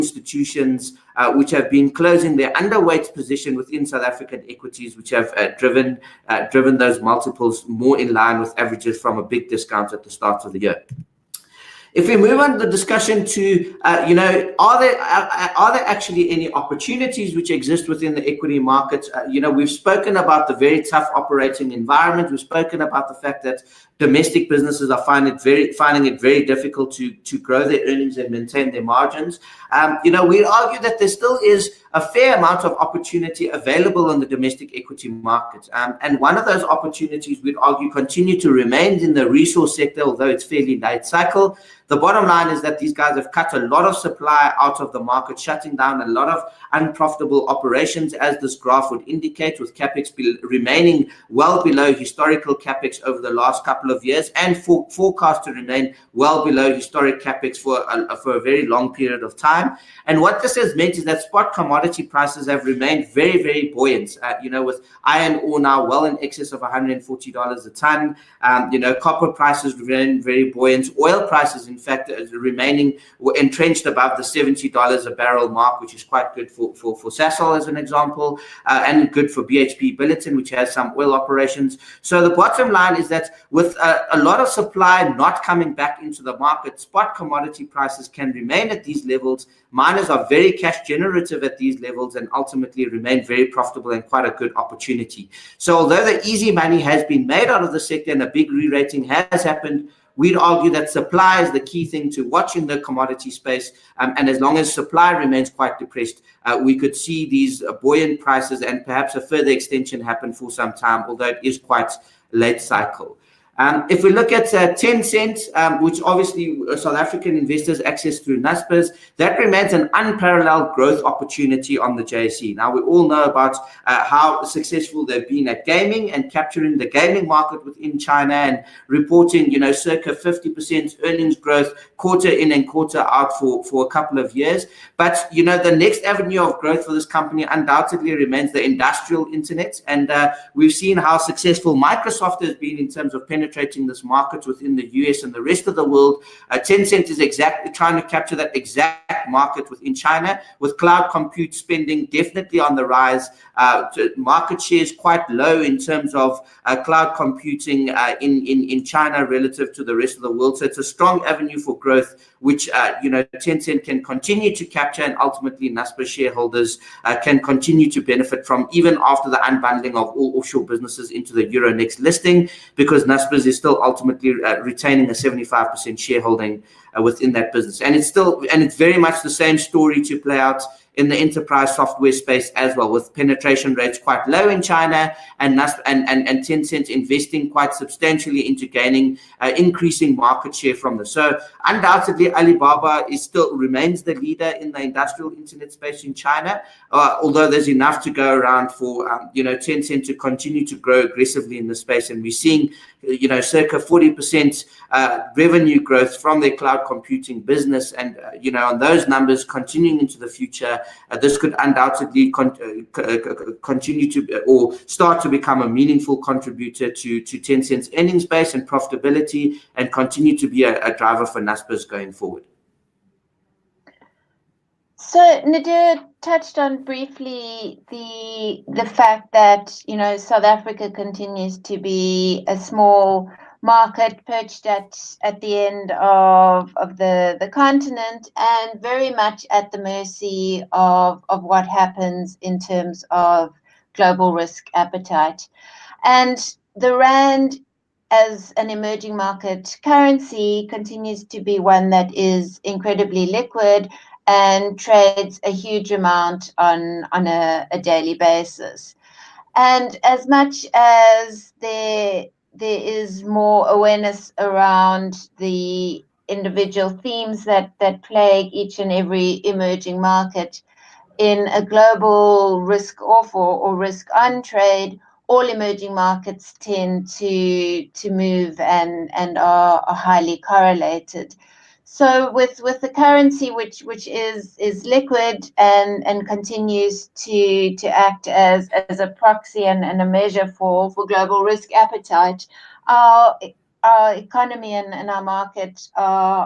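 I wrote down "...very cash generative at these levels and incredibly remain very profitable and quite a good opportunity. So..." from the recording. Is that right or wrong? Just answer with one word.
wrong.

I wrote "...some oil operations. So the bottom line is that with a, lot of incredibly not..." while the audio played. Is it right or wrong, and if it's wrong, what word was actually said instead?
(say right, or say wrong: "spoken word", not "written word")
wrong: "supply", not "incredibly".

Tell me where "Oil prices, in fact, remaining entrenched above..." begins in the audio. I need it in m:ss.
1:11.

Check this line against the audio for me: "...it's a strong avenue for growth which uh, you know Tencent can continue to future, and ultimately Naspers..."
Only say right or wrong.
wrong.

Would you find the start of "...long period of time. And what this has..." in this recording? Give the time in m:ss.
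0:58.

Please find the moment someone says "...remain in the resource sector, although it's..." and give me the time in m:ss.
0:38.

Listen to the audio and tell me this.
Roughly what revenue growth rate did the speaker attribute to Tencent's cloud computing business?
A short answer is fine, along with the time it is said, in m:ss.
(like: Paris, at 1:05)
40%, at 3:23.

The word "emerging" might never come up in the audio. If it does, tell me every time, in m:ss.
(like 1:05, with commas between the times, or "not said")
4:08, 4:29, 4:35.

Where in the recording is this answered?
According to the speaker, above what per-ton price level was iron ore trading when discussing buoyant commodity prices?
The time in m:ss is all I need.
1:06.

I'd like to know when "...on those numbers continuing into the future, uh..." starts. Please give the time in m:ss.
3:28.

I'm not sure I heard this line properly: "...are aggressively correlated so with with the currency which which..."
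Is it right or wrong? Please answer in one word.
wrong.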